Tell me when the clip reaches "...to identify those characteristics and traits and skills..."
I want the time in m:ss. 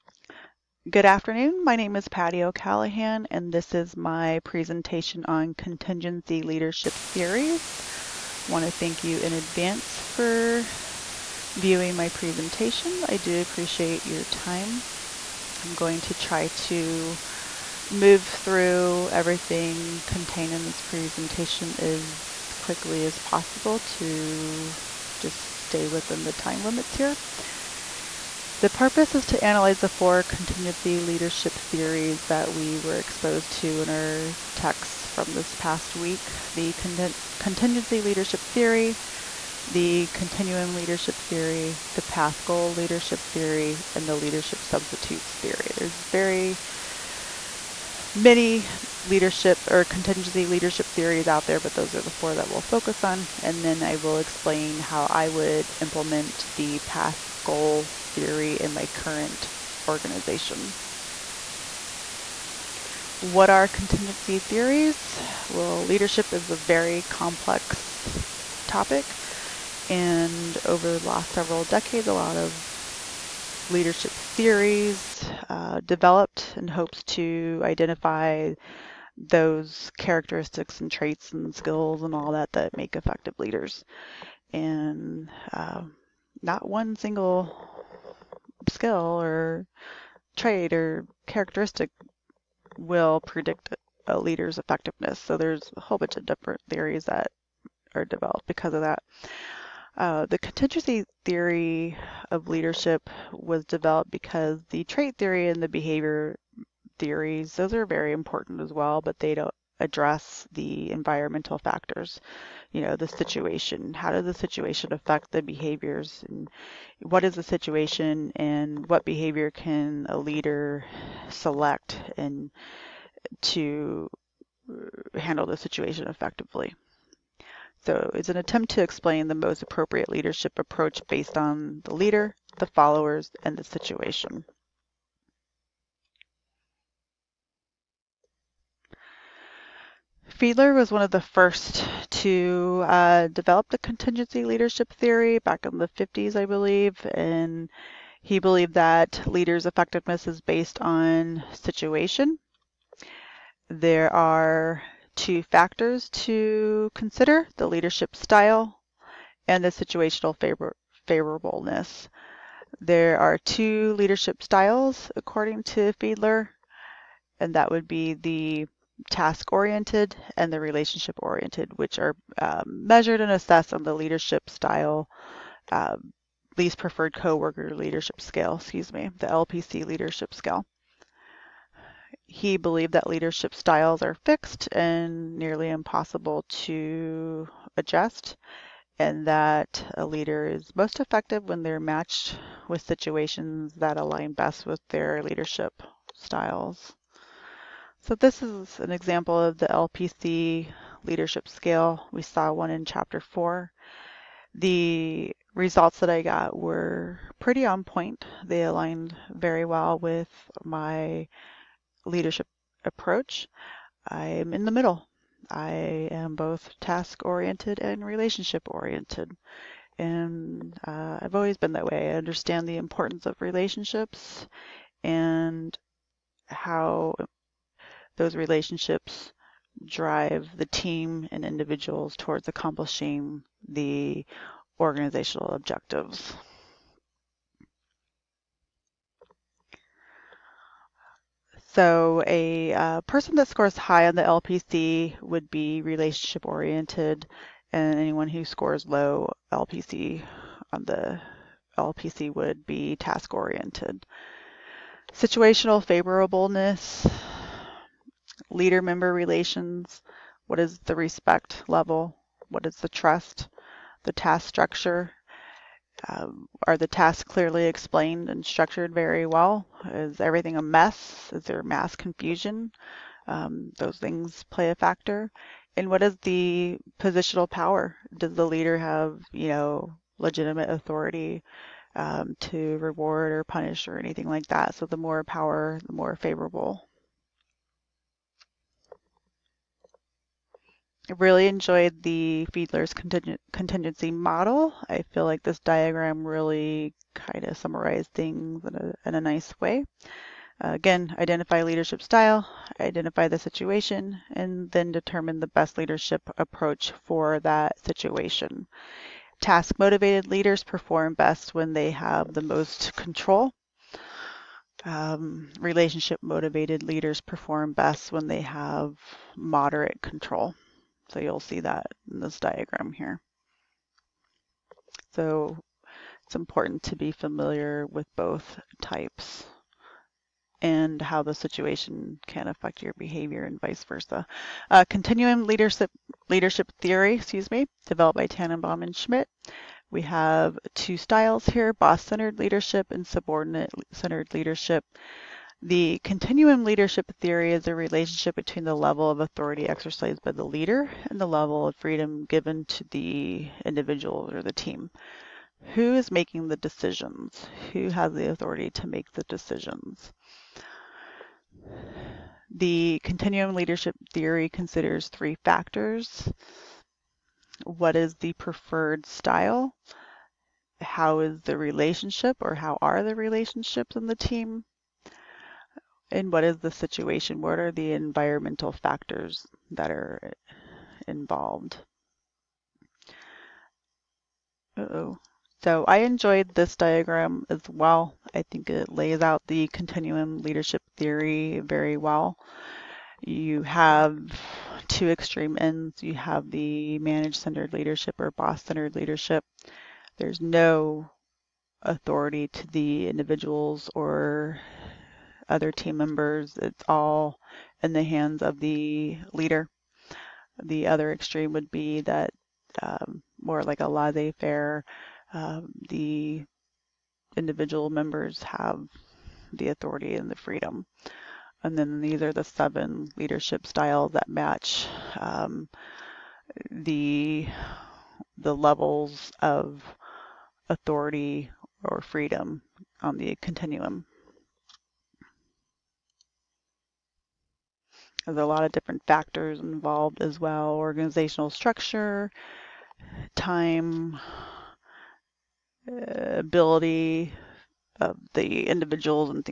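1:17.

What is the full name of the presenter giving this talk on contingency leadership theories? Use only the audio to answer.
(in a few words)
Patty O'Callaghan.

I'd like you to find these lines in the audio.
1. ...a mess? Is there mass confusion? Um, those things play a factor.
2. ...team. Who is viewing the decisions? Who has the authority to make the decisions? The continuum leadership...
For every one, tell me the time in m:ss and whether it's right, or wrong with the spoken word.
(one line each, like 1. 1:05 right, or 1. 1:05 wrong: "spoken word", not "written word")
1. 4:30 right
2. 5:54 wrong: "making", not "viewing".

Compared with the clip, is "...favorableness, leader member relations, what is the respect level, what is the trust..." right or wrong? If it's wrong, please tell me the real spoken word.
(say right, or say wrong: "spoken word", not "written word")
right.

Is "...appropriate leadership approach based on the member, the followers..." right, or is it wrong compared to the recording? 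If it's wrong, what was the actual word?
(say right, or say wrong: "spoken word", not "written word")
wrong: "leader", not "member".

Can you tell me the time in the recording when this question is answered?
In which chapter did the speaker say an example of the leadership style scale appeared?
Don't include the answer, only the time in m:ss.
3:22.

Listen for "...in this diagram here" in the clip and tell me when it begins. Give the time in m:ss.
5:22.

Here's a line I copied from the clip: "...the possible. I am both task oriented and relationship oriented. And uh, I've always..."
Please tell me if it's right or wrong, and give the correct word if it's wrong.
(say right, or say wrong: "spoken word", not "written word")
wrong: "middle", not "possible".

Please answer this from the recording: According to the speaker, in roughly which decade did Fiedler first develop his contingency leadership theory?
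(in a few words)
the 50s.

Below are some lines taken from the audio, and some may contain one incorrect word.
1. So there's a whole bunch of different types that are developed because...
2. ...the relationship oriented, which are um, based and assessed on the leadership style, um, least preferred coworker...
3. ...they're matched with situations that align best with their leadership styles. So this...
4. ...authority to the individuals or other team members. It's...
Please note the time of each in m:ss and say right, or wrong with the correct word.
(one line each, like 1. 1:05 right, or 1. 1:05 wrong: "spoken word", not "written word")
1. 1:35 wrong: "theories", not "types"
2. 2:50 wrong: "measured", not "based"
3. 3:11 right
4. 6:41 right.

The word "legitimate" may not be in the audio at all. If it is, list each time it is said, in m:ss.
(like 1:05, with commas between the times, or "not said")
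4:40.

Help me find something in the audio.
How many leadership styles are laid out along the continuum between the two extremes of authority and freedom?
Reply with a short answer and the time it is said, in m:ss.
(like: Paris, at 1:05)
7, at 7:02.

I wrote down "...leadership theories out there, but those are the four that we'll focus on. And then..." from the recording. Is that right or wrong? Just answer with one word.
right.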